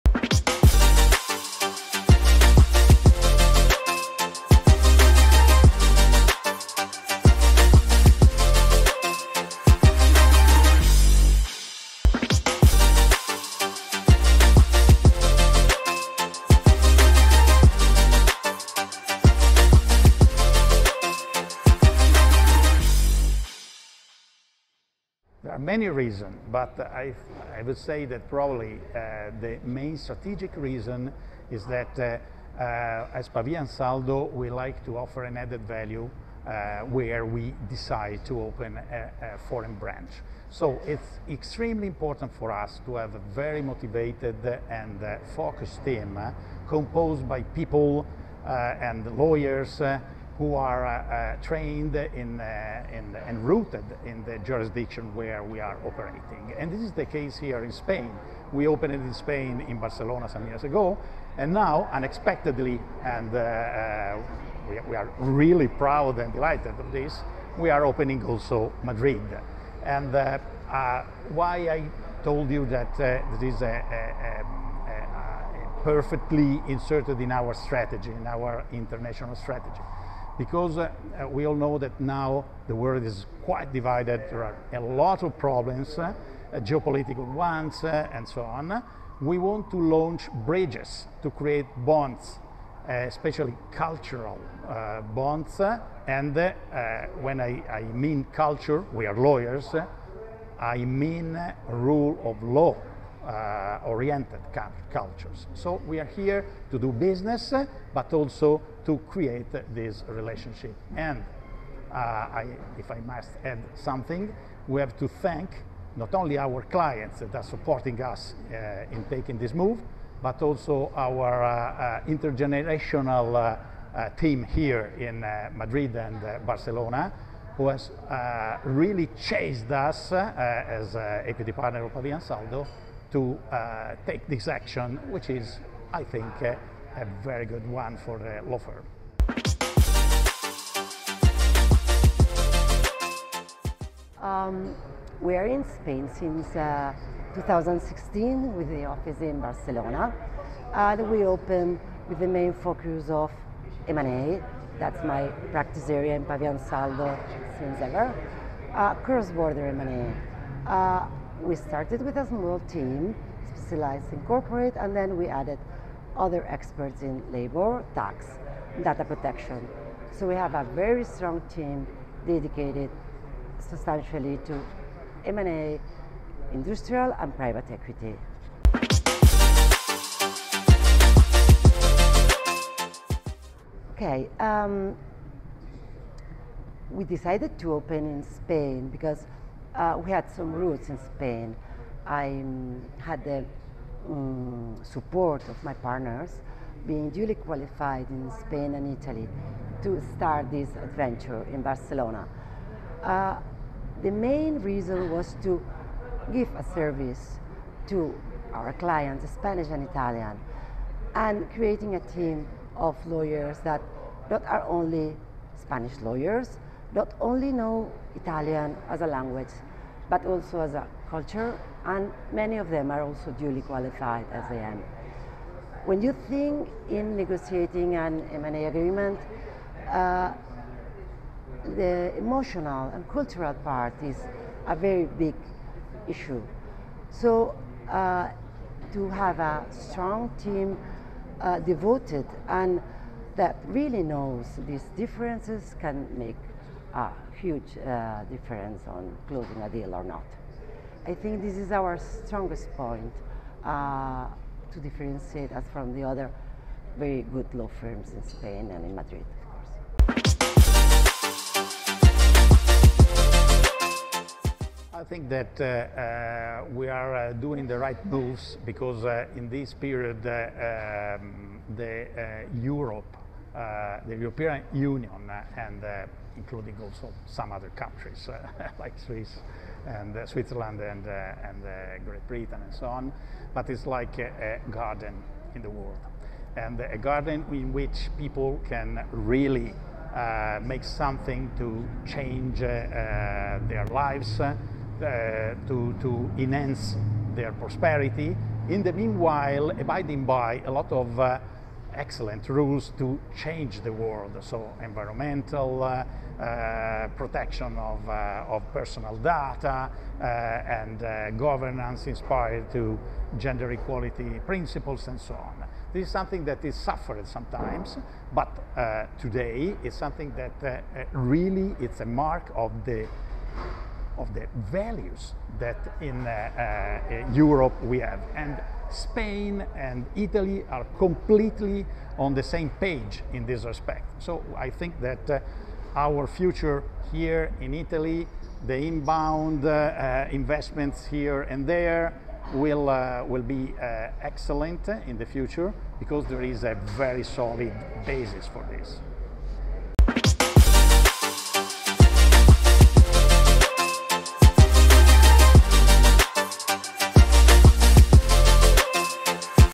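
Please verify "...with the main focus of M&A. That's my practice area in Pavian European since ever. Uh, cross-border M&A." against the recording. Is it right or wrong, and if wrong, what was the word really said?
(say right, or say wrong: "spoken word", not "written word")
wrong: "Saldo", not "European".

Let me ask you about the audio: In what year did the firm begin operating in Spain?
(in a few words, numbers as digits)
2016.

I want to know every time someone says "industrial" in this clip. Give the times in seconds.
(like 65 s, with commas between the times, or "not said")
176 s.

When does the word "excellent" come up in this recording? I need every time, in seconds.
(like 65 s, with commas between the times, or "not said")
301 s, 344 s.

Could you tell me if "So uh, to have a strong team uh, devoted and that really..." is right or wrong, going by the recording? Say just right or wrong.
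right.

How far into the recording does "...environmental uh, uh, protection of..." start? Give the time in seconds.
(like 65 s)
304 s.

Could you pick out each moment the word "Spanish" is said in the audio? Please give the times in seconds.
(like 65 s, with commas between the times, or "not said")
209 s, 215 s.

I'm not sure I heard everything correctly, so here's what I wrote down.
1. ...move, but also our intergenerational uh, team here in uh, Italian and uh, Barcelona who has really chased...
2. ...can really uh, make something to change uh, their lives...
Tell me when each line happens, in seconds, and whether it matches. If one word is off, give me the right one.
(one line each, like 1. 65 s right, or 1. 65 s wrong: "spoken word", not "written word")
1. 119 s wrong: "Madrid", not "Italian"
2. 288 s right.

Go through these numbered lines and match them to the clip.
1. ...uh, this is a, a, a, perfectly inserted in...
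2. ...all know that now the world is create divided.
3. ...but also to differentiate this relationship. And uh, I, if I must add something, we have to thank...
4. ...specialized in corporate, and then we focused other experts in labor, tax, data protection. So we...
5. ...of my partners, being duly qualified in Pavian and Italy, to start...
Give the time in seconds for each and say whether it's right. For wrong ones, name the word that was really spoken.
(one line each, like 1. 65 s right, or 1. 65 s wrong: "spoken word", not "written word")
1. 72 s right
2. 81 s wrong: "quite", not "create"
3. 107 s wrong: "create", not "differentiate"
4. 163 s wrong: "added", not "focused"
5. 195 s wrong: "Spain", not "Pavian".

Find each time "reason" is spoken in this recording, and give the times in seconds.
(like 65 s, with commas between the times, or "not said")
25 s, 30 s, 204 s.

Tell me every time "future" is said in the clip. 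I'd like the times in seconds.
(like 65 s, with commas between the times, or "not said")
336 s, 345 s.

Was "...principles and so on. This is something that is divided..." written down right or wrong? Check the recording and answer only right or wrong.
wrong.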